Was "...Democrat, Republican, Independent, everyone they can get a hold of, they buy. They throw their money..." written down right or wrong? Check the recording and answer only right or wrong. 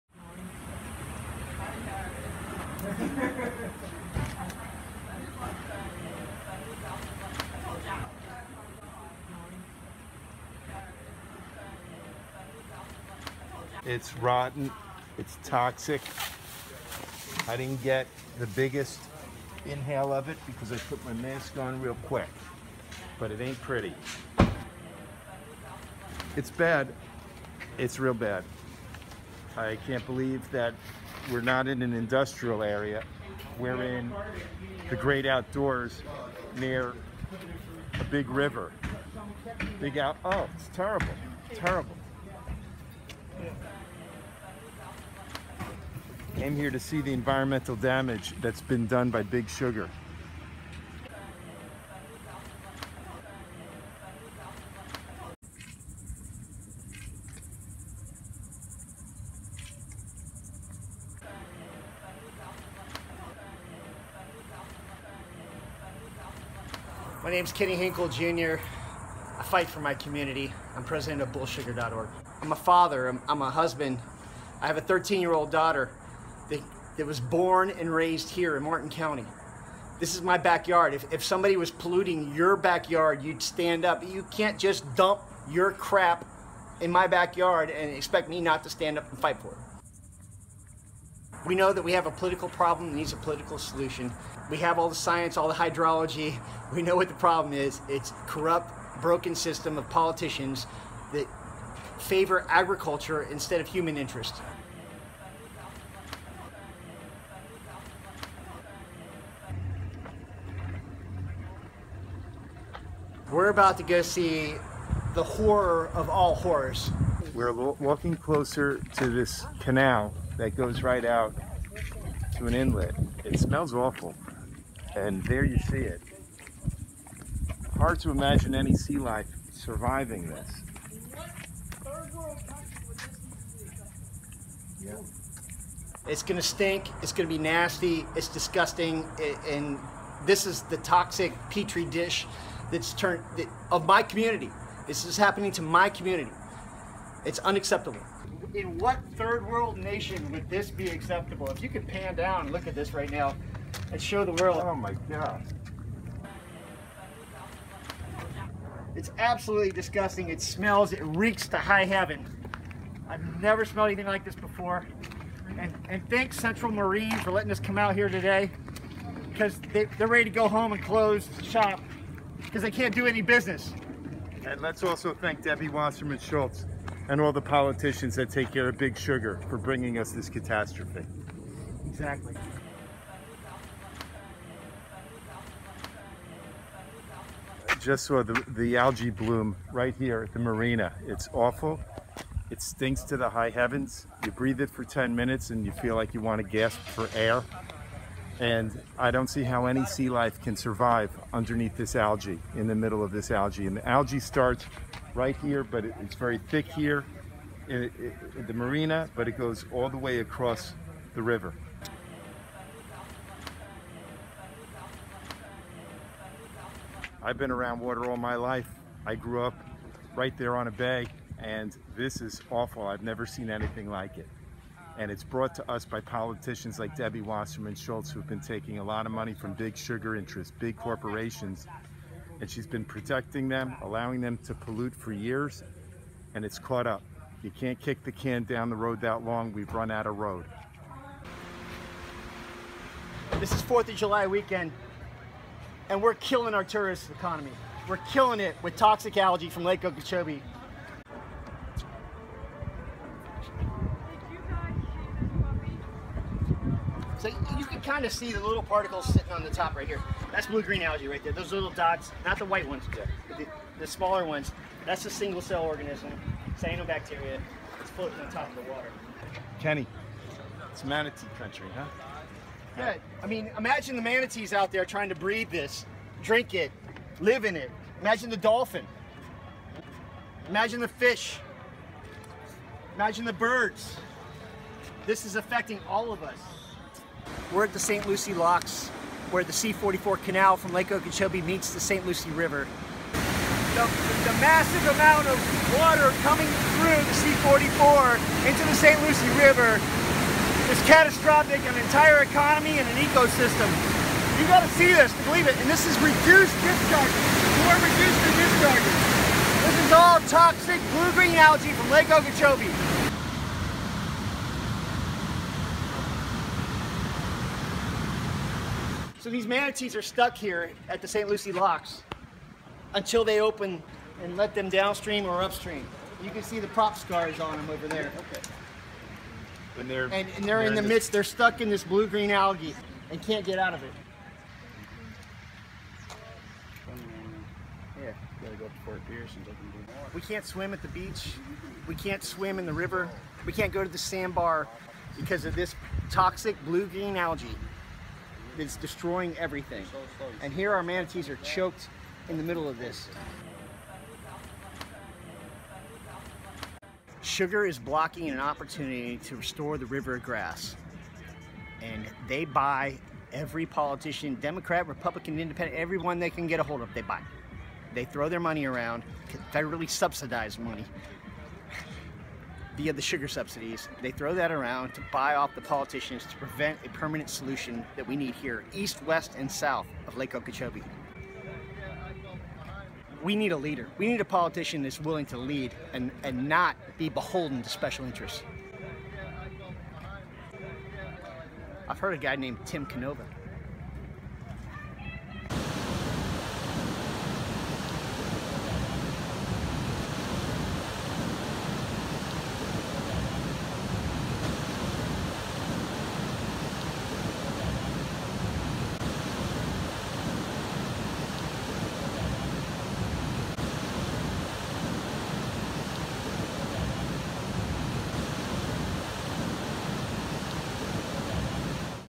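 right.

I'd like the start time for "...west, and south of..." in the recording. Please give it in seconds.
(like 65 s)
379 s.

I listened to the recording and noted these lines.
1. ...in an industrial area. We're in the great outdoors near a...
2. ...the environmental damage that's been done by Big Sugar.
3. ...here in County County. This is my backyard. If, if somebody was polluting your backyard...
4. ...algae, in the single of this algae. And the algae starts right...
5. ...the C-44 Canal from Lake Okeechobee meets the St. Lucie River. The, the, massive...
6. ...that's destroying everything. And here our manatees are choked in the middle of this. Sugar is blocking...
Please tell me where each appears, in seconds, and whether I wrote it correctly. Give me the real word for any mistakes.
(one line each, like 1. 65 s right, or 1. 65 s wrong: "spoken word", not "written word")
1. 31 s right
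2. 47 s right
3. 78 s wrong: "Martin", not "County"
4. 201 s wrong: "middle", not "single"
5. 289 s right
6. 348 s right.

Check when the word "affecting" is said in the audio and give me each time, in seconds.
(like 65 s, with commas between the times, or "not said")
285 s.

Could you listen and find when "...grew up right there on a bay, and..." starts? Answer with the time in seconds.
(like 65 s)
219 s.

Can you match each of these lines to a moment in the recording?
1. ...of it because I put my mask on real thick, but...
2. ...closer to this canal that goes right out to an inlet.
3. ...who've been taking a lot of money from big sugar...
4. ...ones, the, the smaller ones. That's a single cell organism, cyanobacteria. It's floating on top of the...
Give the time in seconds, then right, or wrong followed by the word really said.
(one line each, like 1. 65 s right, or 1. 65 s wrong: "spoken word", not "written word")
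1. 20 s wrong: "quick", not "thick"
2. 118 s right
3. 228 s right
4. 262 s right.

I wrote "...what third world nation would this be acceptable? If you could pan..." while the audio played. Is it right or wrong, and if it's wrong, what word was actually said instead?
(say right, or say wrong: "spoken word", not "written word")
right.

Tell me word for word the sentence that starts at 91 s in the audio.
We know that we have a political problem that needs a political solution.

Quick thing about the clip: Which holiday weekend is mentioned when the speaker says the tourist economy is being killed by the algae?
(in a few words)
4th of July.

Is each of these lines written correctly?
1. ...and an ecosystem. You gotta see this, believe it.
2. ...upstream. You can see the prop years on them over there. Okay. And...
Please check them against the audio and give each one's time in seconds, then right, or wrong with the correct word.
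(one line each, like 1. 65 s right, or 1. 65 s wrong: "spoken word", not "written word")
1. 302 s right
2. 325 s wrong: "scars", not "years".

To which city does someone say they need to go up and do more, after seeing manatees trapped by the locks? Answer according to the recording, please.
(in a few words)
Fort Pierce.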